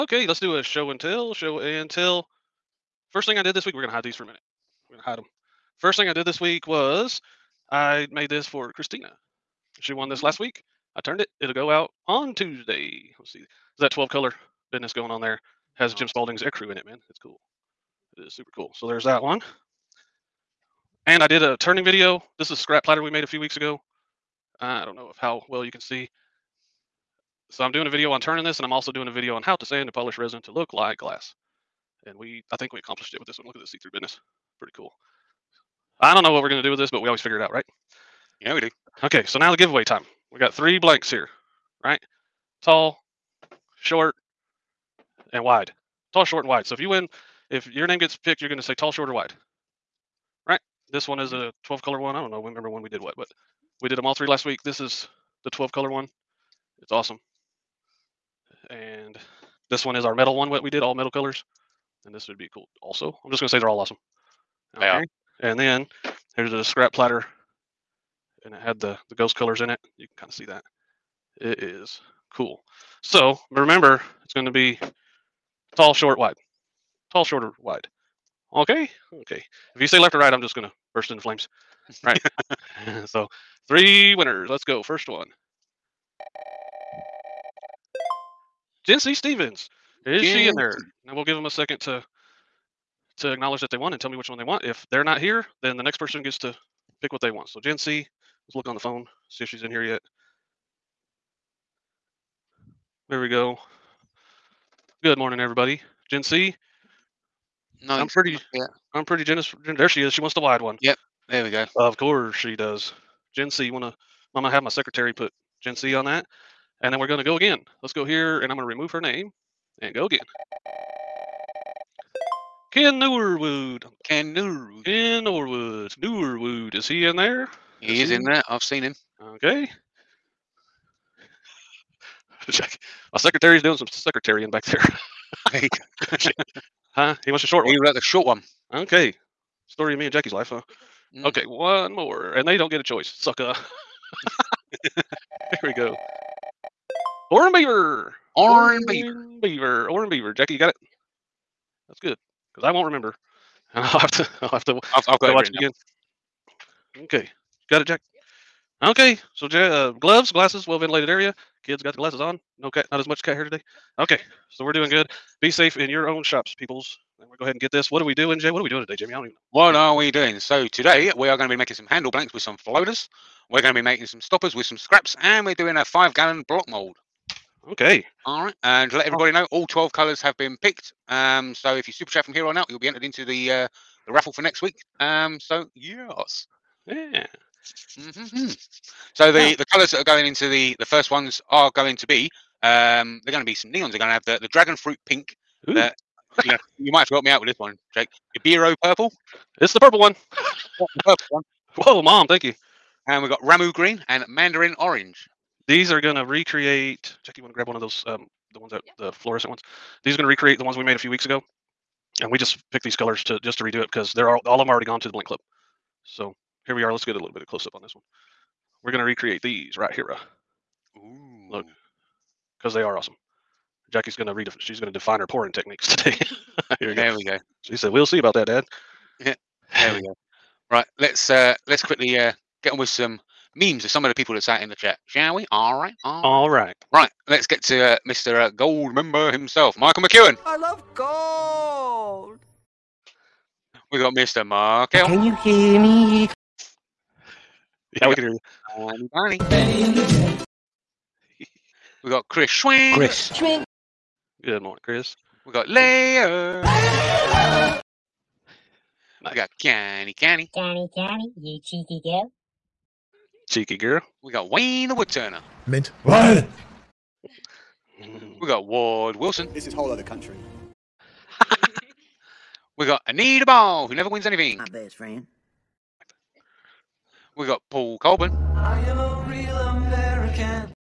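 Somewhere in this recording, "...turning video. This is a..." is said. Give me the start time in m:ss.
0:21.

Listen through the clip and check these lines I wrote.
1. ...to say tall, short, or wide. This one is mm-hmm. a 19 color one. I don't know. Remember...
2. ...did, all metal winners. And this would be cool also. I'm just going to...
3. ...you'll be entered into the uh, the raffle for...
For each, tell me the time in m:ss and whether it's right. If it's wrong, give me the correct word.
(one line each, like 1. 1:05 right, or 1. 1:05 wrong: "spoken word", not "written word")
1. 0:48 wrong: "12", not "19"
2. 1:00 wrong: "colors", not "winners"
3. 3:02 right.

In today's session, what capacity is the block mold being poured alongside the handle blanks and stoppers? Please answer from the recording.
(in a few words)
5 gallons.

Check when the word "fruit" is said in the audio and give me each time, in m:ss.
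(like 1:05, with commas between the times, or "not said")
3:14.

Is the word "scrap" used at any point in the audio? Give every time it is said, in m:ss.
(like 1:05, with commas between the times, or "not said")
0:22, 1:06, 2:54.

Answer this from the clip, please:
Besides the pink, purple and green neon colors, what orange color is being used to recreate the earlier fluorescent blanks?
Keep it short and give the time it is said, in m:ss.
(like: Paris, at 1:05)
Mandarin Orange, at 3:24.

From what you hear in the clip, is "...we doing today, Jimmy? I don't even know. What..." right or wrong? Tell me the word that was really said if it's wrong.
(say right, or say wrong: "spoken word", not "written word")
right.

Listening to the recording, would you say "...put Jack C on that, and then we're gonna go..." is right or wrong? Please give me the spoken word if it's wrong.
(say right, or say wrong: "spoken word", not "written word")
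wrong: "Jen", not "Jack".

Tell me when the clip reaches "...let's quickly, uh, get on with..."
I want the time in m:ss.
3:51.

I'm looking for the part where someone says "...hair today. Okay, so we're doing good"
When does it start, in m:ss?
2:43.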